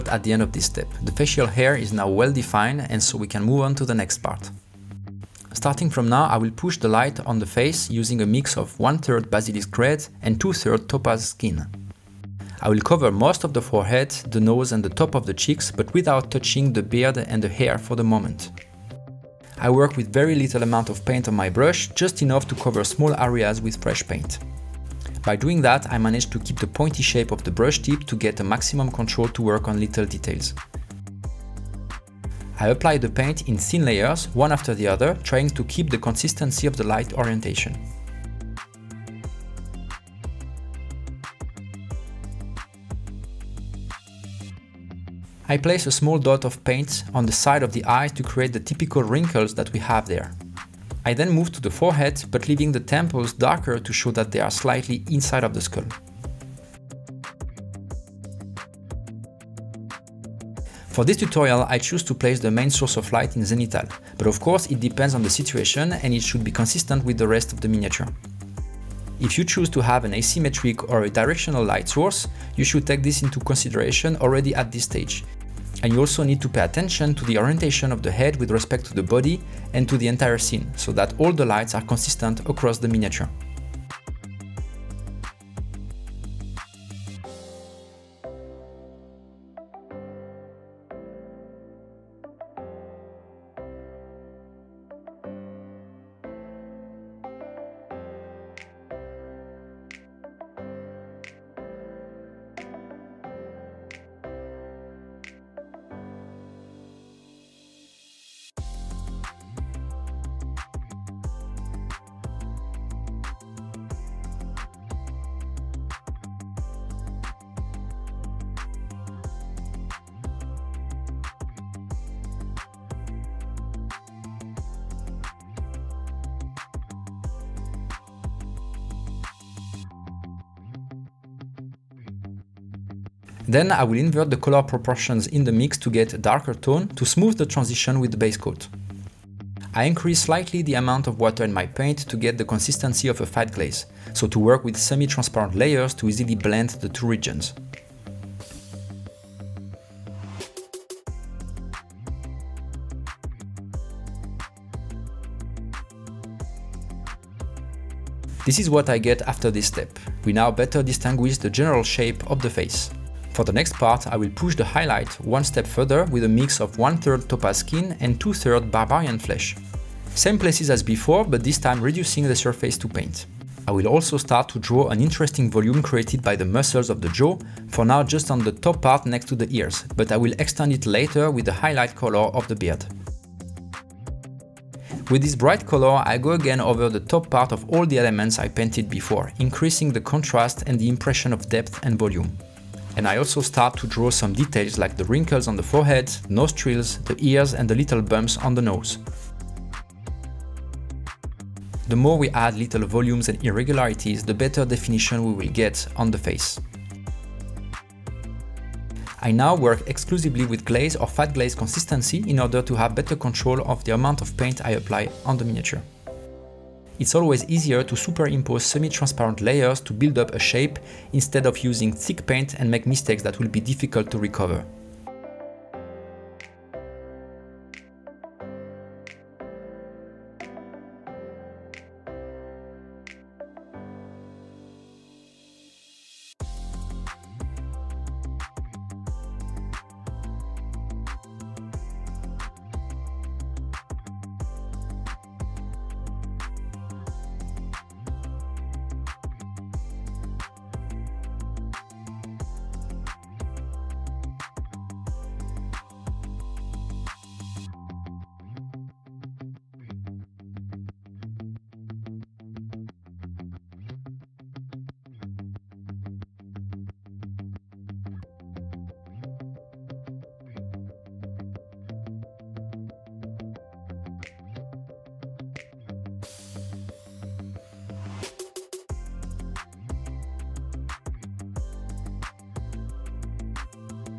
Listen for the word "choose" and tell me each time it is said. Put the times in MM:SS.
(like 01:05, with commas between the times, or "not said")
01:01, 01:09.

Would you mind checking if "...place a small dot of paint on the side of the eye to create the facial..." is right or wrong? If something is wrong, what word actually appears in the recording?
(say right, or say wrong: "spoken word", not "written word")
wrong: "typical", not "facial".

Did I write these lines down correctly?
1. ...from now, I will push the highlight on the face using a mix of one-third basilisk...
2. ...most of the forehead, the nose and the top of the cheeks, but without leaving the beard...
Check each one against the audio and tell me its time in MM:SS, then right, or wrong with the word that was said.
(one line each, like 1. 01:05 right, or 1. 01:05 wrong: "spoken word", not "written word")
1. 00:05 wrong: "light", not "highlight"
2. 00:13 wrong: "touching", not "leaving".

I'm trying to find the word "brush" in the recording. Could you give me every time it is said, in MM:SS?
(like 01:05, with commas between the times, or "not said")
00:21, 00:27.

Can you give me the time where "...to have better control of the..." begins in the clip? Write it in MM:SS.
03:32.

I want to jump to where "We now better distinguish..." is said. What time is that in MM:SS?
02:40.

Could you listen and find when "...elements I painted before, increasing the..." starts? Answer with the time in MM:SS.
03:07.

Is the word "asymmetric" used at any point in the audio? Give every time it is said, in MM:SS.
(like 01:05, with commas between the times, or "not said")
01:10.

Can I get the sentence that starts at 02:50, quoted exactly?
Same places as before, but this time reducing the surface to paint.